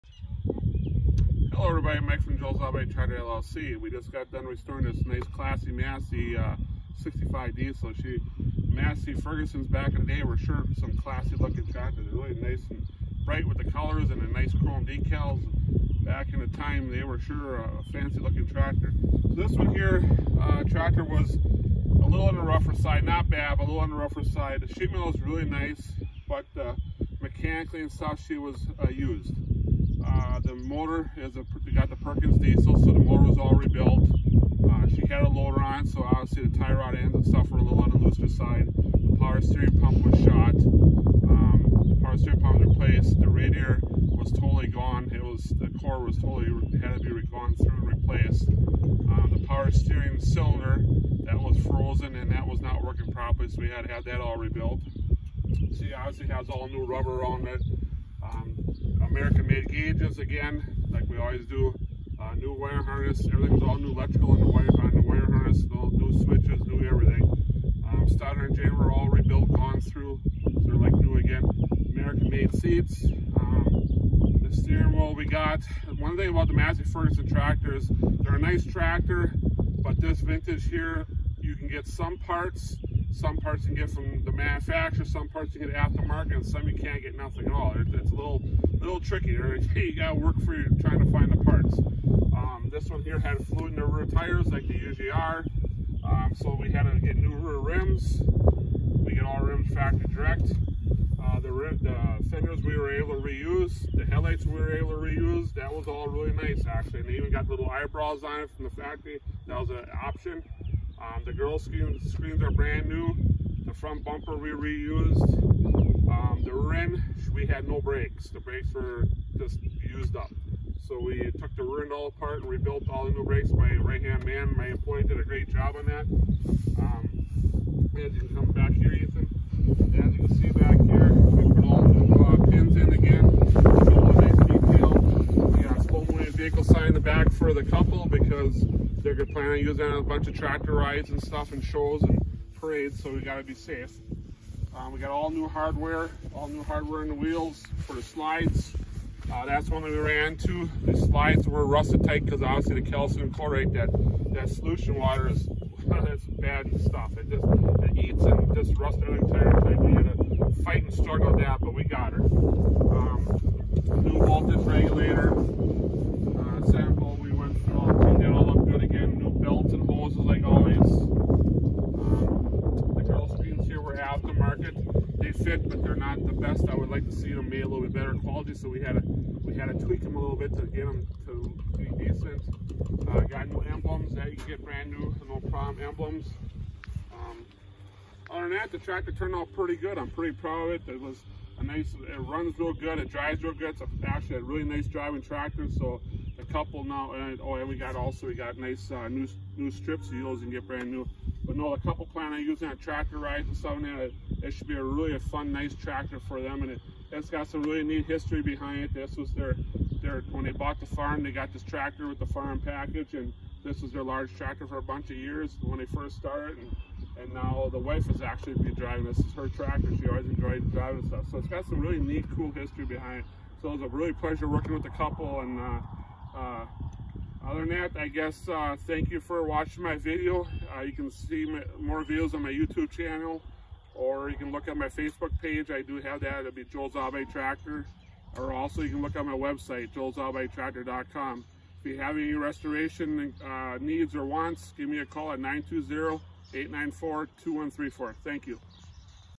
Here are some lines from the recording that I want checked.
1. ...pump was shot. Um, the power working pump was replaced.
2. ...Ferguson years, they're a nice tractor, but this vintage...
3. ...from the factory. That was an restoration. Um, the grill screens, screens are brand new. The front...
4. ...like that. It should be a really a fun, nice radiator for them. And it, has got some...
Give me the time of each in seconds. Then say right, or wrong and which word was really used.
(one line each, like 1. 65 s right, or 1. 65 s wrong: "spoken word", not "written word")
1. 39 s wrong: "steering", not "working"
2. 76 s wrong: "tractors", not "years"
3. 108 s wrong: "option", not "restoration"
4. 203 s wrong: "tractor", not "radiator".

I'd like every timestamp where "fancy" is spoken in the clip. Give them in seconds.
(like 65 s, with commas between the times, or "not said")
17 s.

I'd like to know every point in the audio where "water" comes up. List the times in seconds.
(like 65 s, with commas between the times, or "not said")
154 s.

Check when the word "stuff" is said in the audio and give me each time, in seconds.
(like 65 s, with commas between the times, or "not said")
27 s, 37 s, 141 s, 156 s, 203 s, 221 s.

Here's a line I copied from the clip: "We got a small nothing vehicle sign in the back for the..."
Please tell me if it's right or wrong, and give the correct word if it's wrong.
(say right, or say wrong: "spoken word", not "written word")
wrong: "moving", not "nothing".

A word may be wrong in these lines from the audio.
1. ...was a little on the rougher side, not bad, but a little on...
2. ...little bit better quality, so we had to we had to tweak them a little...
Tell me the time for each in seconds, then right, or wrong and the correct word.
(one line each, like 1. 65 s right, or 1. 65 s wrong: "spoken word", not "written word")
1. 21 s right
2. 177 s right.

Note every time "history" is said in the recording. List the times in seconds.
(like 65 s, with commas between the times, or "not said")
208 s, 222 s.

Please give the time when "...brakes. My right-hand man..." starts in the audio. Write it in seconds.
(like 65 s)
123 s.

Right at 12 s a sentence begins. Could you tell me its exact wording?
They're really nice and bright with the colors and the nice chrome decals.